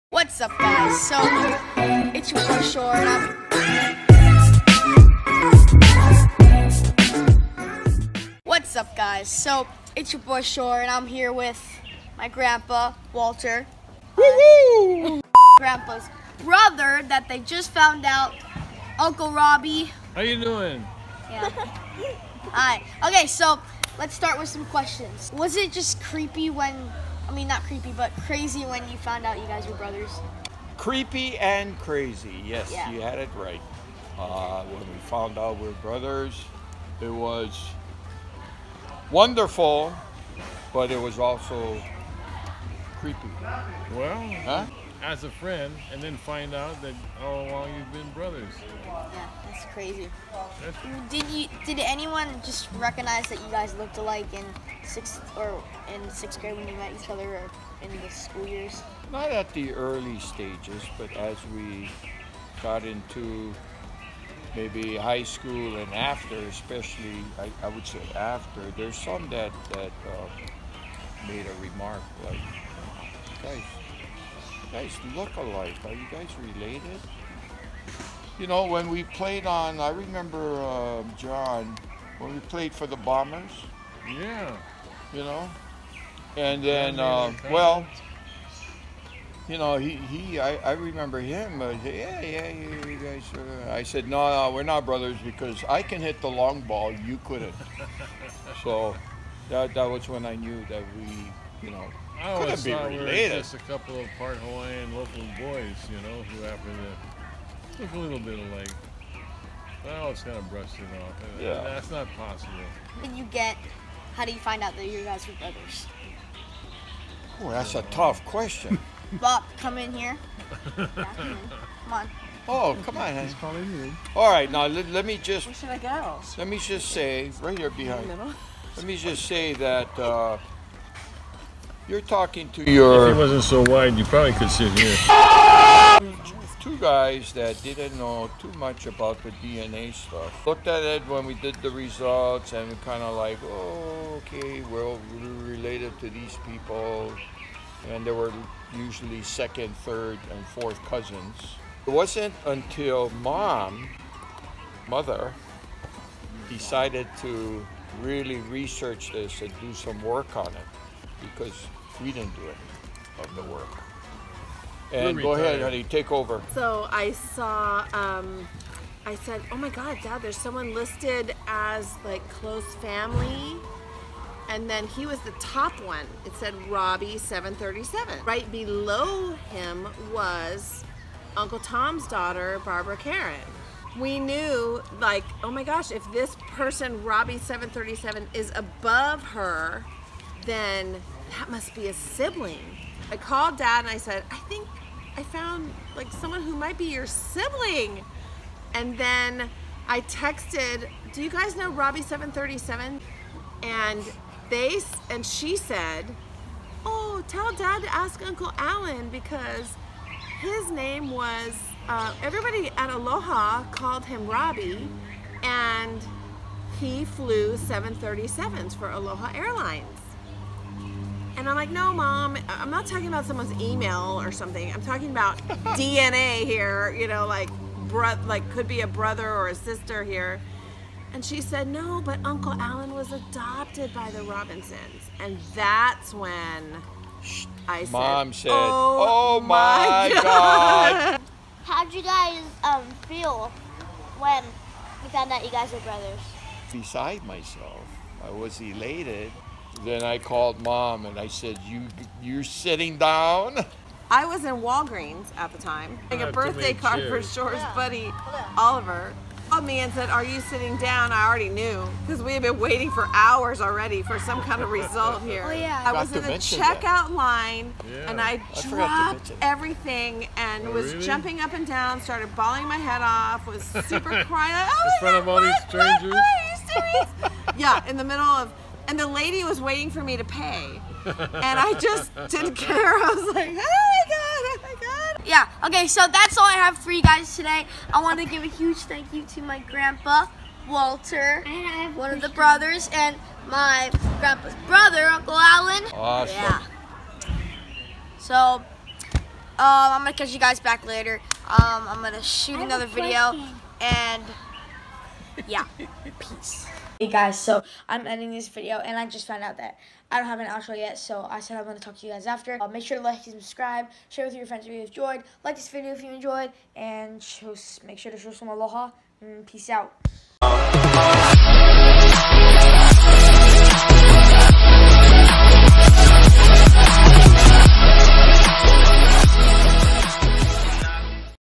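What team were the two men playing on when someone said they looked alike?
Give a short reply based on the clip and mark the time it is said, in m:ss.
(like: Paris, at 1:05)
the Bombers, at 1:22.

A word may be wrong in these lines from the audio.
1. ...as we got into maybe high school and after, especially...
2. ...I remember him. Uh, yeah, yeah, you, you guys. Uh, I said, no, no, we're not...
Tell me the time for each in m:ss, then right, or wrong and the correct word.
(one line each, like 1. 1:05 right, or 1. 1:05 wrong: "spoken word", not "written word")
1. 1:01 right
2. 1:30 right.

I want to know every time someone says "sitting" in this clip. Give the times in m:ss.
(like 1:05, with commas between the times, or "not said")
4:12, 4:20.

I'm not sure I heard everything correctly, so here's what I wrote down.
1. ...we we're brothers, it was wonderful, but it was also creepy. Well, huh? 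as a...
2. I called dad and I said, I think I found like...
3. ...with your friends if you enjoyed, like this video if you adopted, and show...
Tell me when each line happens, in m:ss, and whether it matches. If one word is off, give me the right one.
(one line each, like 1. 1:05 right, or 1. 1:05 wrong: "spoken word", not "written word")
1. 0:35 right
2. 3:13 right
3. 5:14 wrong: "enjoyed", not "adopted".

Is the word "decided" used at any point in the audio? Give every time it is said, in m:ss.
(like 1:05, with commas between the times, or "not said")
2:36.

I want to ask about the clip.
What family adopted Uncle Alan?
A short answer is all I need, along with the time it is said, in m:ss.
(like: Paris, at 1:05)
the Robinsons, at 3:54.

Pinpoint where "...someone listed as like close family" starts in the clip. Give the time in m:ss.
2:50.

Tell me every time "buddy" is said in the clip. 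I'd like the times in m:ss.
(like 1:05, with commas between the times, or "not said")
4:17.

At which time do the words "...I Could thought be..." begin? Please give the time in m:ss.
1:42.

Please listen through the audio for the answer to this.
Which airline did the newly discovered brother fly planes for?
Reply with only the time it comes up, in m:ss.
3:38.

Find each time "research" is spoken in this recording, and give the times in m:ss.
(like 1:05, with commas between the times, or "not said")
2:38.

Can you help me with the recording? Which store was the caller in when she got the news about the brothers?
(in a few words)
Walgreens.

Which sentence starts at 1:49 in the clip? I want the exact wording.
Well, it's kind of brushed it off.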